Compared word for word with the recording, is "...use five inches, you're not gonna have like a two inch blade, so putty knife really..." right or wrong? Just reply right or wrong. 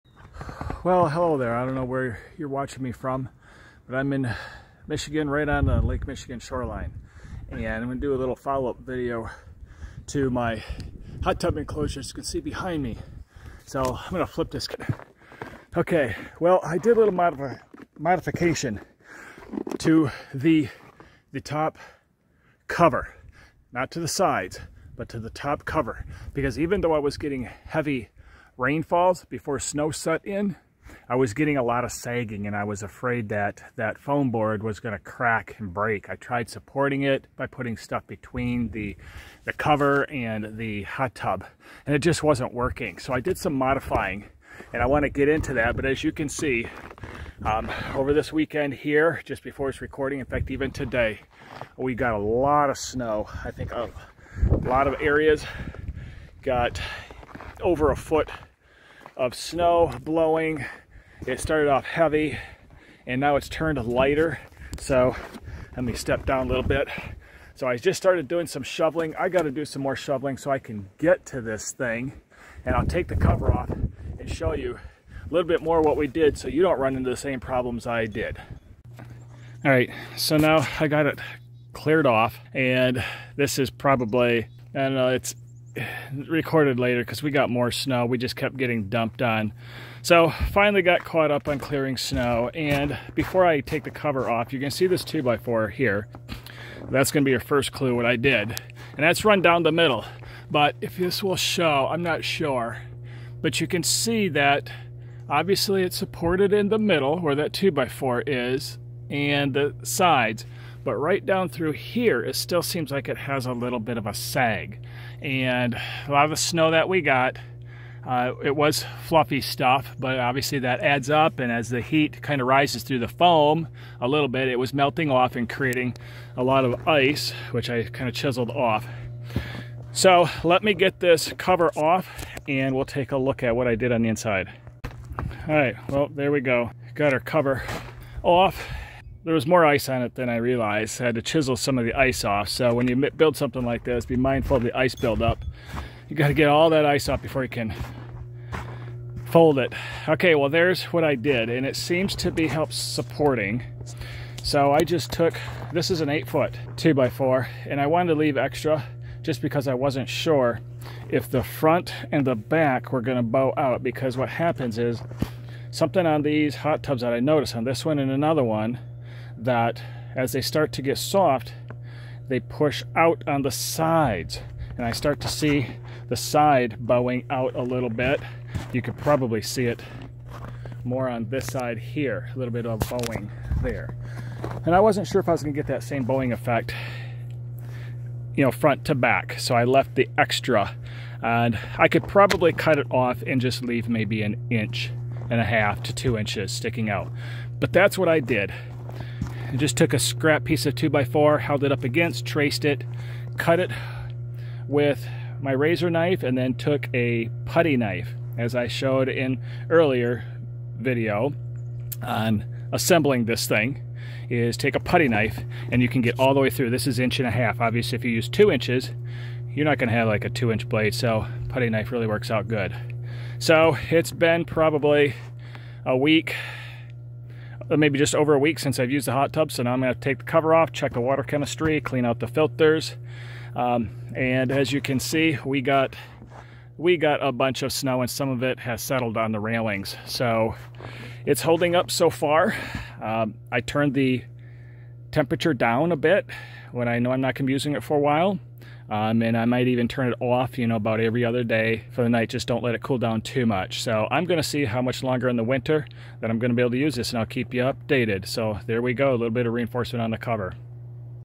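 wrong.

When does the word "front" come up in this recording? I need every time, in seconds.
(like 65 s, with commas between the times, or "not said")
161 s, 188 s.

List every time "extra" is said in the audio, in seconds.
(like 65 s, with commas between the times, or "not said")
158 s, 190 s.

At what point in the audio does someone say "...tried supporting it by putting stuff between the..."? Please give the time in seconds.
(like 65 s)
36 s.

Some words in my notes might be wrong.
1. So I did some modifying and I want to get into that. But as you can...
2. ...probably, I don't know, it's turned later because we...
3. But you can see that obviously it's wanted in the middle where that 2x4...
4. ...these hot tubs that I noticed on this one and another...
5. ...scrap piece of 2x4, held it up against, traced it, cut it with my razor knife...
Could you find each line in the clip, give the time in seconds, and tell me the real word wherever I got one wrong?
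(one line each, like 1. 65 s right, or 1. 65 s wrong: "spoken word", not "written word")
1. 42 s right
2. 83 s wrong: "recorded", not "turned"
3. 103 s wrong: "supported", not "wanted"
4. 166 s right
5. 199 s right.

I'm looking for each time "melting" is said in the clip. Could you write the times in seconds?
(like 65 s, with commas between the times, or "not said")
124 s.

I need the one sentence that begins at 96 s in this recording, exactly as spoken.
That's going to be your first clue what I did.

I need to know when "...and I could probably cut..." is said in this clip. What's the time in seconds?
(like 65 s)
191 s.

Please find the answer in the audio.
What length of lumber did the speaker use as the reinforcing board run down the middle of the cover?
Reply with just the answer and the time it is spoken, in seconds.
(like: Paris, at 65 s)
8 foot, at 156 s.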